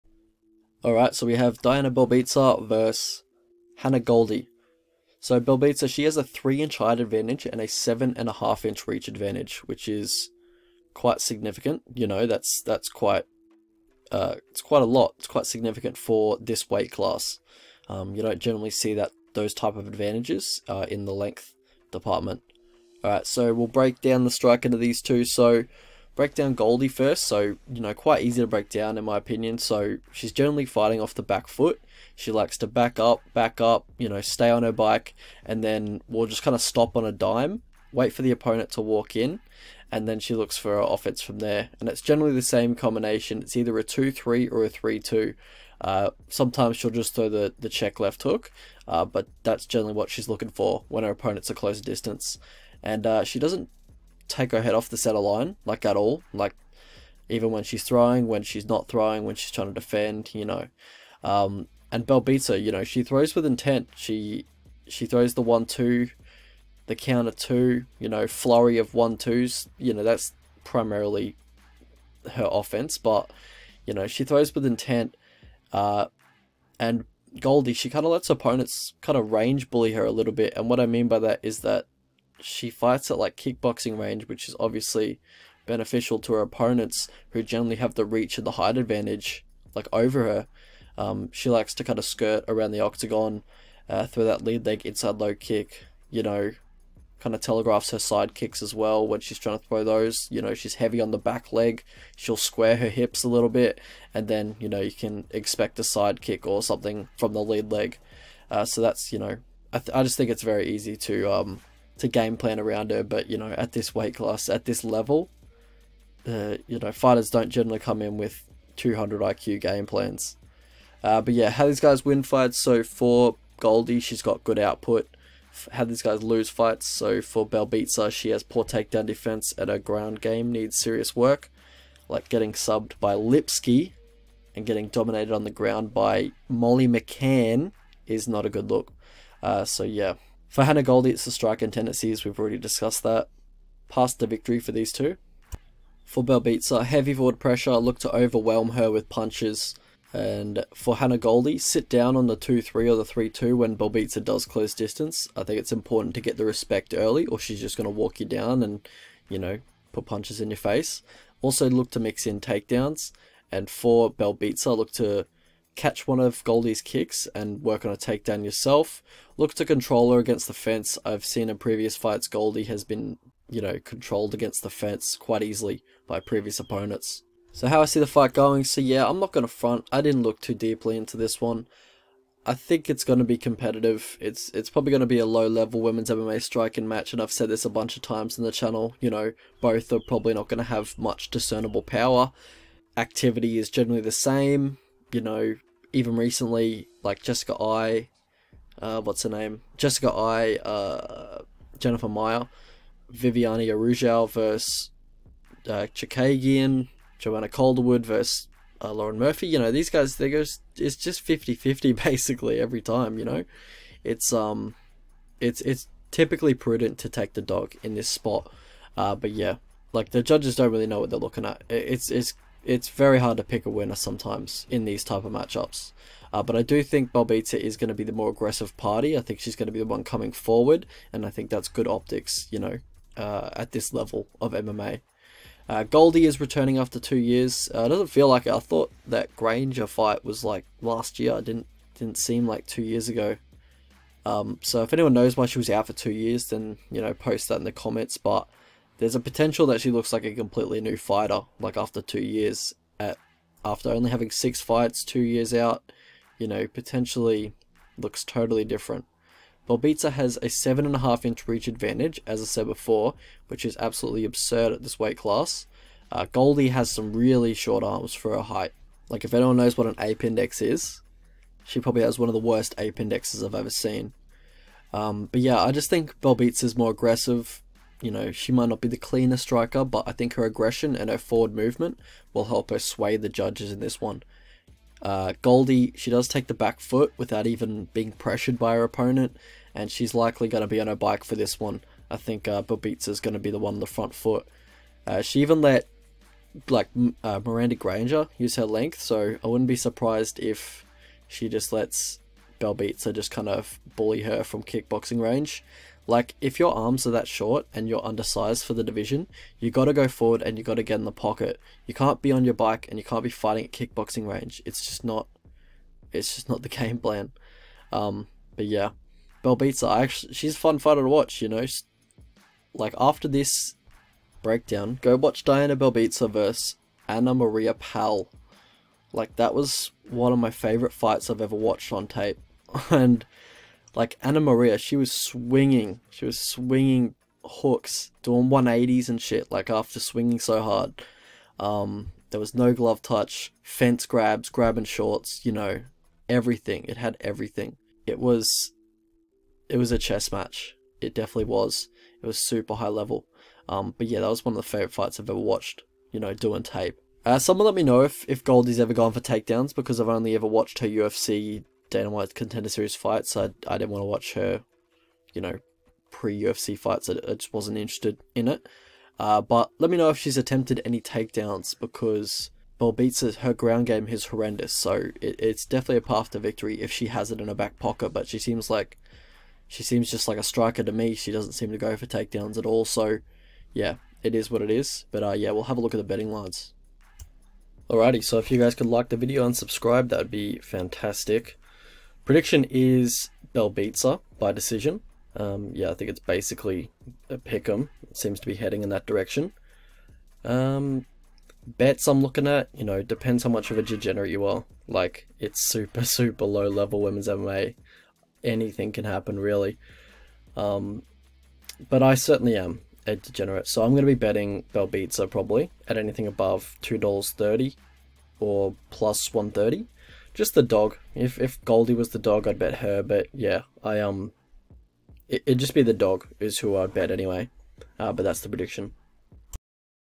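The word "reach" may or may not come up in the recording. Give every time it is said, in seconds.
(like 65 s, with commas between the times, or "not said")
8 s, 88 s, 261 s.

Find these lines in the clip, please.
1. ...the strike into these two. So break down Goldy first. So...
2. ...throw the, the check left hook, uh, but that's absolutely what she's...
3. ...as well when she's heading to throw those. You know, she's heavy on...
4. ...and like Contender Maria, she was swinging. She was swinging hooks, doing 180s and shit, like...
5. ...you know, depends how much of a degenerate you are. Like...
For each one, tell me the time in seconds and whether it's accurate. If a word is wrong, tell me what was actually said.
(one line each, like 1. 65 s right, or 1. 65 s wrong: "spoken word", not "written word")
1. 24 s right
2. 47 s wrong: "generally", not "absolutely"
3. 98 s wrong: "trying", not "heading"
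4. 332 s wrong: "Anna", not "Contender"
5. 402 s right.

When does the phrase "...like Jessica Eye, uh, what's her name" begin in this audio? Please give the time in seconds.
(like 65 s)
197 s.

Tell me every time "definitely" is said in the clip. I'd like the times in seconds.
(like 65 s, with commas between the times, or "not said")
351 s, 375 s.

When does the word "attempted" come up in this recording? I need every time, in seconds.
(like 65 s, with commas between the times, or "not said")
370 s.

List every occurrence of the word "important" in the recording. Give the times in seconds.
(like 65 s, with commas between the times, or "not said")
155 s.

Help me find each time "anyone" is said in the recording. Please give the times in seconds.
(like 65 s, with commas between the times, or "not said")
244 s, 269 s.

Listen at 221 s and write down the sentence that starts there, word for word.
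It's, it's it's very hard to pick a winner sometimes in these type of matchups.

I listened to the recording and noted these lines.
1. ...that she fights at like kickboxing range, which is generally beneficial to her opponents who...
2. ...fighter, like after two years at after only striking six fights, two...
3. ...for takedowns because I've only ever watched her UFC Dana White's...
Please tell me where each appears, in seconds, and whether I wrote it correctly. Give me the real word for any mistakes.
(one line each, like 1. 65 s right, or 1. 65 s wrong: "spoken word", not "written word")
1. 81 s wrong: "obviously", not "generally"
2. 250 s wrong: "having", not "striking"
3. 359 s right.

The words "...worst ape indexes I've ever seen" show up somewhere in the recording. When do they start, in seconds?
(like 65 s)
272 s.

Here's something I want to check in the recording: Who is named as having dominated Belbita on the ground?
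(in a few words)
Molly McCann.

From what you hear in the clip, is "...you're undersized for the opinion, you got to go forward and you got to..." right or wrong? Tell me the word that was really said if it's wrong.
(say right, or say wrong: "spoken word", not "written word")
wrong: "division", not "opinion".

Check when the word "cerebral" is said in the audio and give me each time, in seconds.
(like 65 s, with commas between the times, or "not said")
not said.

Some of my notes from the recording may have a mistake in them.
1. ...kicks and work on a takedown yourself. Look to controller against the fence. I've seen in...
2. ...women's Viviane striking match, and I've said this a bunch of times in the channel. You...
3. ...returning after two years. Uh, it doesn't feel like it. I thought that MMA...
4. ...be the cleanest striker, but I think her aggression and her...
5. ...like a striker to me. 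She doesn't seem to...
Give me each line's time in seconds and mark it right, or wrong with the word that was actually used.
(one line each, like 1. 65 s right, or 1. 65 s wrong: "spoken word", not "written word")
1. 166 s right
2. 185 s wrong: "MMA", not "Viviane"
3. 236 s wrong: "Granger", not "MMA"
4. 278 s right
5. 380 s right.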